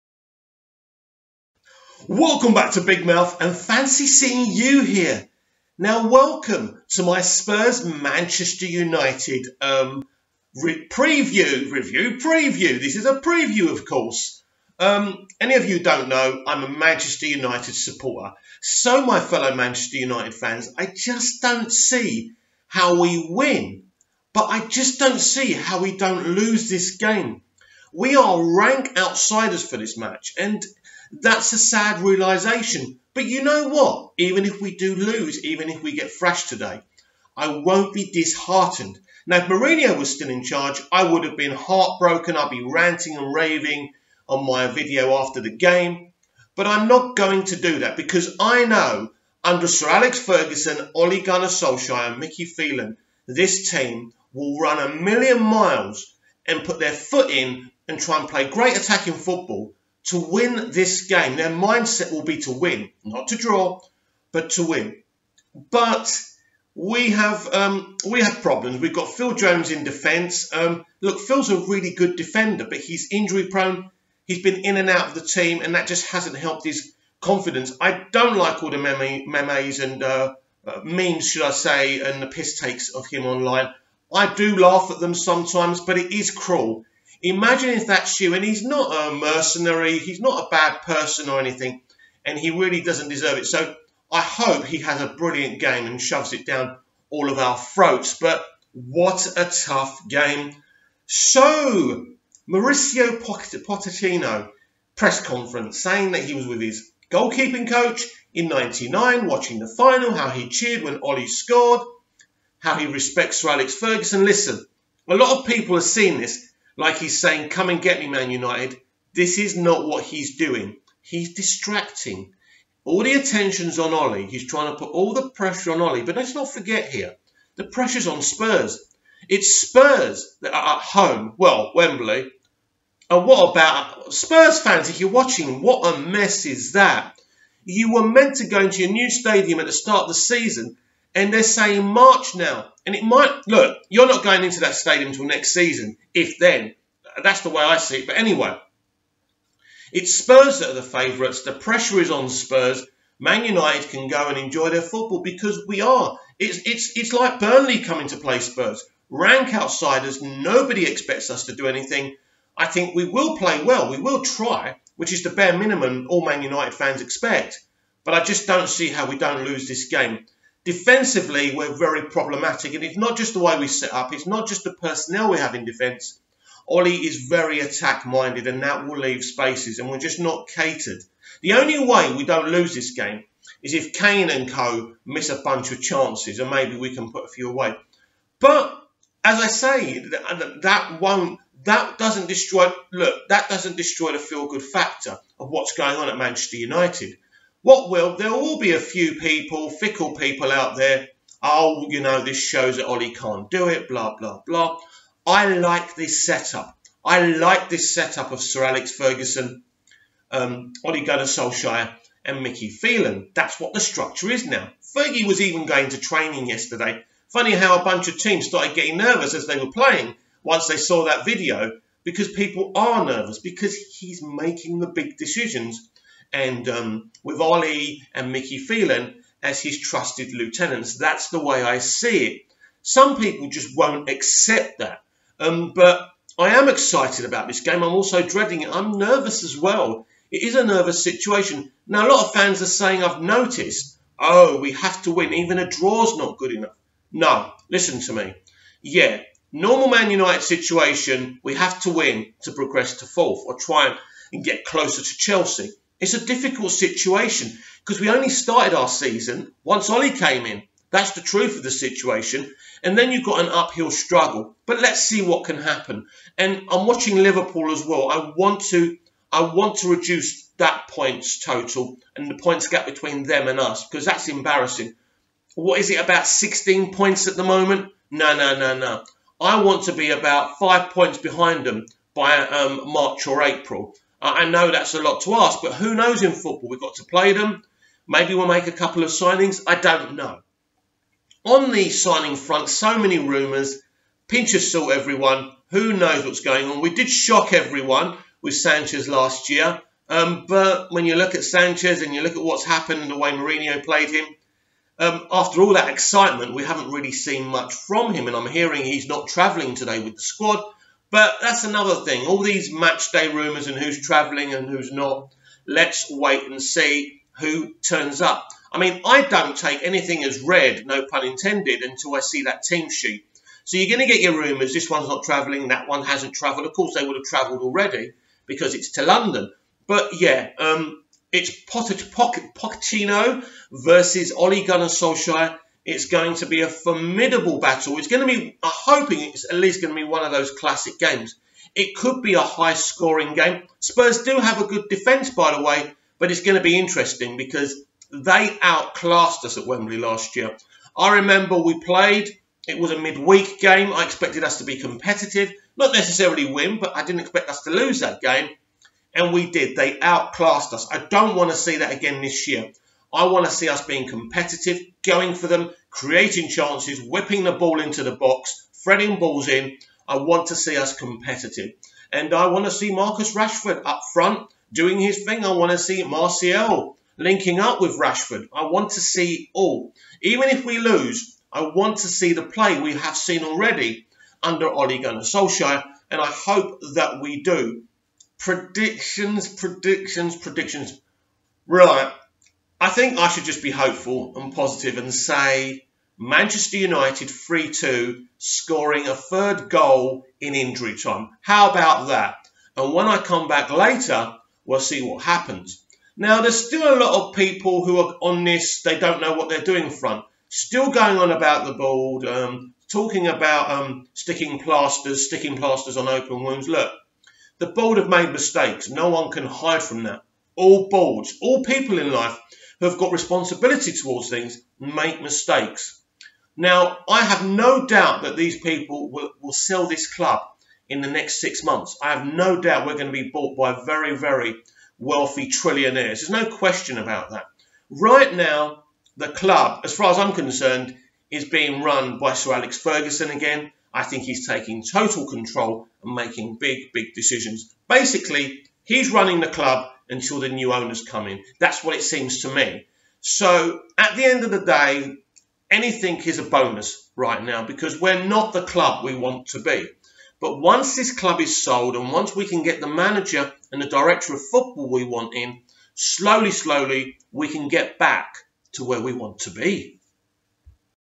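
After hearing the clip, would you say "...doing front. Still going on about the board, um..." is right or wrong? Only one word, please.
right.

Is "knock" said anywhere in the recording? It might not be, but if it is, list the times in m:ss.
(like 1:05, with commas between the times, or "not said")
not said.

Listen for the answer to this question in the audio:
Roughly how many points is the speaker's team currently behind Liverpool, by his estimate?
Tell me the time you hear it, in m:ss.
4:36.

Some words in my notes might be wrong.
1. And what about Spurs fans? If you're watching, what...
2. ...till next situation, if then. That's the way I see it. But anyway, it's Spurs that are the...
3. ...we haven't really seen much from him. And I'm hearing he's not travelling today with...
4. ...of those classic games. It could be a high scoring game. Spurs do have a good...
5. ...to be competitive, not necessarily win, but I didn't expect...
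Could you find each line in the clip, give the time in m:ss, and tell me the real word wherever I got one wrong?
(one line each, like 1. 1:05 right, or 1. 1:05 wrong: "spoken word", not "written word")
1. 2:13 right
2. 2:25 wrong: "season", not "situation"
3. 5:06 right
4. 5:40 right
5. 5:54 right.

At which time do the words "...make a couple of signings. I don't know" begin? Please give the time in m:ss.
4:48.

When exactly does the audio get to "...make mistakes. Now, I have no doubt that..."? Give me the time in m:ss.
7:04.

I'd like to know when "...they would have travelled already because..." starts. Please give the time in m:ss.
5:26.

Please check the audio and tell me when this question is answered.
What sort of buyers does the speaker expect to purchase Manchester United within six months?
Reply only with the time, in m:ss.
7:15.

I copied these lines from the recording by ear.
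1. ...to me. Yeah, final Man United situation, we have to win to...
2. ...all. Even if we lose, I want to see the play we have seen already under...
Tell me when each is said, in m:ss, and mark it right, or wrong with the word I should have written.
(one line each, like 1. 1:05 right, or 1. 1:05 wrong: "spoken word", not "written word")
1. 4:08 wrong: "normal", not "final"
2. 6:19 right.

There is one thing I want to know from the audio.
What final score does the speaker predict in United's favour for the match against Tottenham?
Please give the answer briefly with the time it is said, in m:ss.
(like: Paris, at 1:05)
3-2, at 6:37.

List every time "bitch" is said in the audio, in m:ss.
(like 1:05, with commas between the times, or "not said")
not said.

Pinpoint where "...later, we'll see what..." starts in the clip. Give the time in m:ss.
6:43.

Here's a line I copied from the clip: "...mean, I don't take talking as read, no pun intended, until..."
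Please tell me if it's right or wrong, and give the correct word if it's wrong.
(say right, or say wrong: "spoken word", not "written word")
wrong: "anything", not "talking".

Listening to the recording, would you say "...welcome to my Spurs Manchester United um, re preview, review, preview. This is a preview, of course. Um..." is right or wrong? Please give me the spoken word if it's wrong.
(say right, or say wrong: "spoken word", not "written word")
right.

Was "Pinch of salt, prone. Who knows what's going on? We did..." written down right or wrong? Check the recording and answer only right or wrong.
wrong.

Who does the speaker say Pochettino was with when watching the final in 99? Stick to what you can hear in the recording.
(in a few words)
his goalkeeping coach.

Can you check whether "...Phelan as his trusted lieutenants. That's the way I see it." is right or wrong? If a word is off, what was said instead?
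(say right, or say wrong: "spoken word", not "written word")
right.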